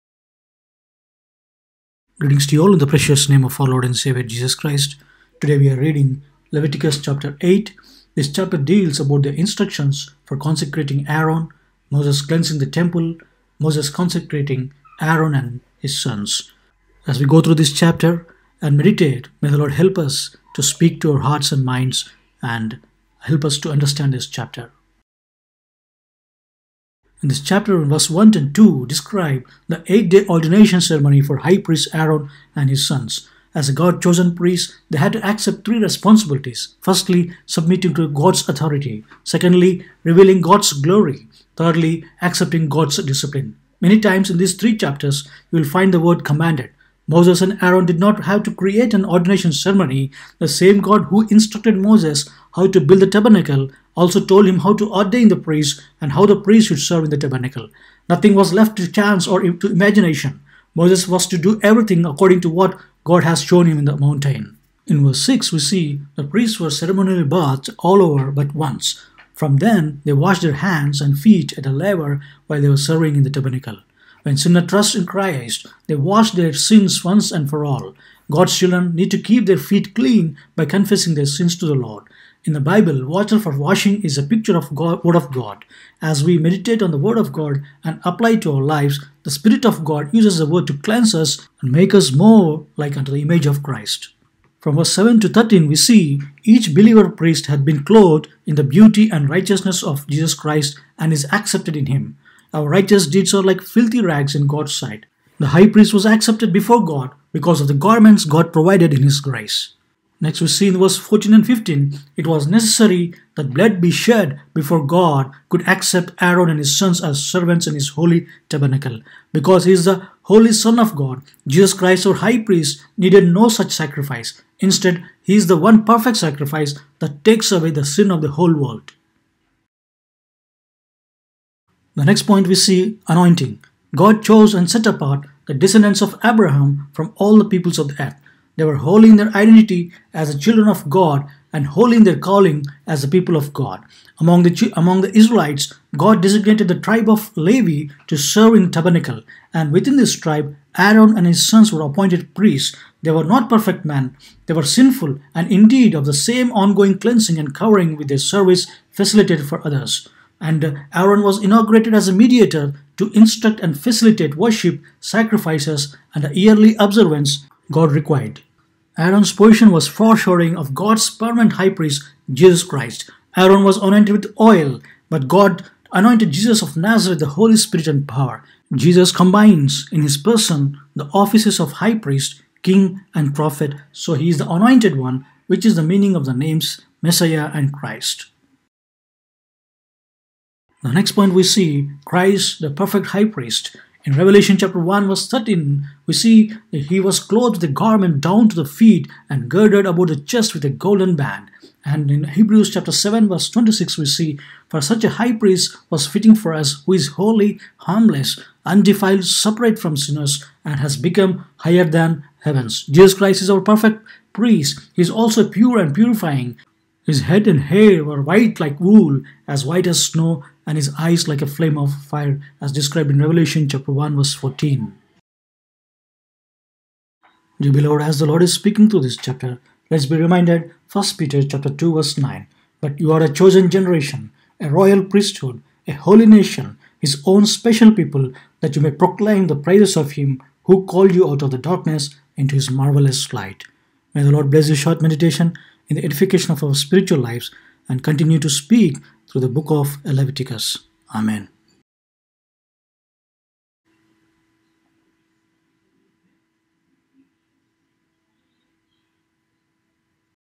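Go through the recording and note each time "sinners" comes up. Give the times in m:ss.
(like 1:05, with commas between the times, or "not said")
1:14, 3:29.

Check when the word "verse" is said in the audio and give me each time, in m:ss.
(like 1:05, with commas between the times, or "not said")
0:27, 1:05, 1:34, 1:50, 3:15, 3:23, 3:44, 3:51.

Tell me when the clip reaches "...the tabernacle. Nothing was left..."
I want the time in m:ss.
0:57.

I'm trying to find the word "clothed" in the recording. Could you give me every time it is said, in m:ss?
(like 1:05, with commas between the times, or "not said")
1:37, 3:17.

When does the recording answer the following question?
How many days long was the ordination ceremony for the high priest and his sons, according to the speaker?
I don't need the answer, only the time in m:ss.
0:29.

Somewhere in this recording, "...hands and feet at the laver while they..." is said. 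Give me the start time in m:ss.
1:10.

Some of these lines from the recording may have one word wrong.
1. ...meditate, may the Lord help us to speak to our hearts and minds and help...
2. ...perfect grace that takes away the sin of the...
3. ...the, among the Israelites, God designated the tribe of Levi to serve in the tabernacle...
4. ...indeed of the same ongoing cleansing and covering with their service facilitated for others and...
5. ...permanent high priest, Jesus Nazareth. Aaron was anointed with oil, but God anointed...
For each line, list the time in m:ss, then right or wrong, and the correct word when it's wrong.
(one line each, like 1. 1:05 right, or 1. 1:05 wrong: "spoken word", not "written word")
1. 0:18 right
2. 2:05 wrong: "sacrifice", not "grace"
3. 2:24 right
4. 2:35 right
5. 2:51 wrong: "Christ", not "Nazareth".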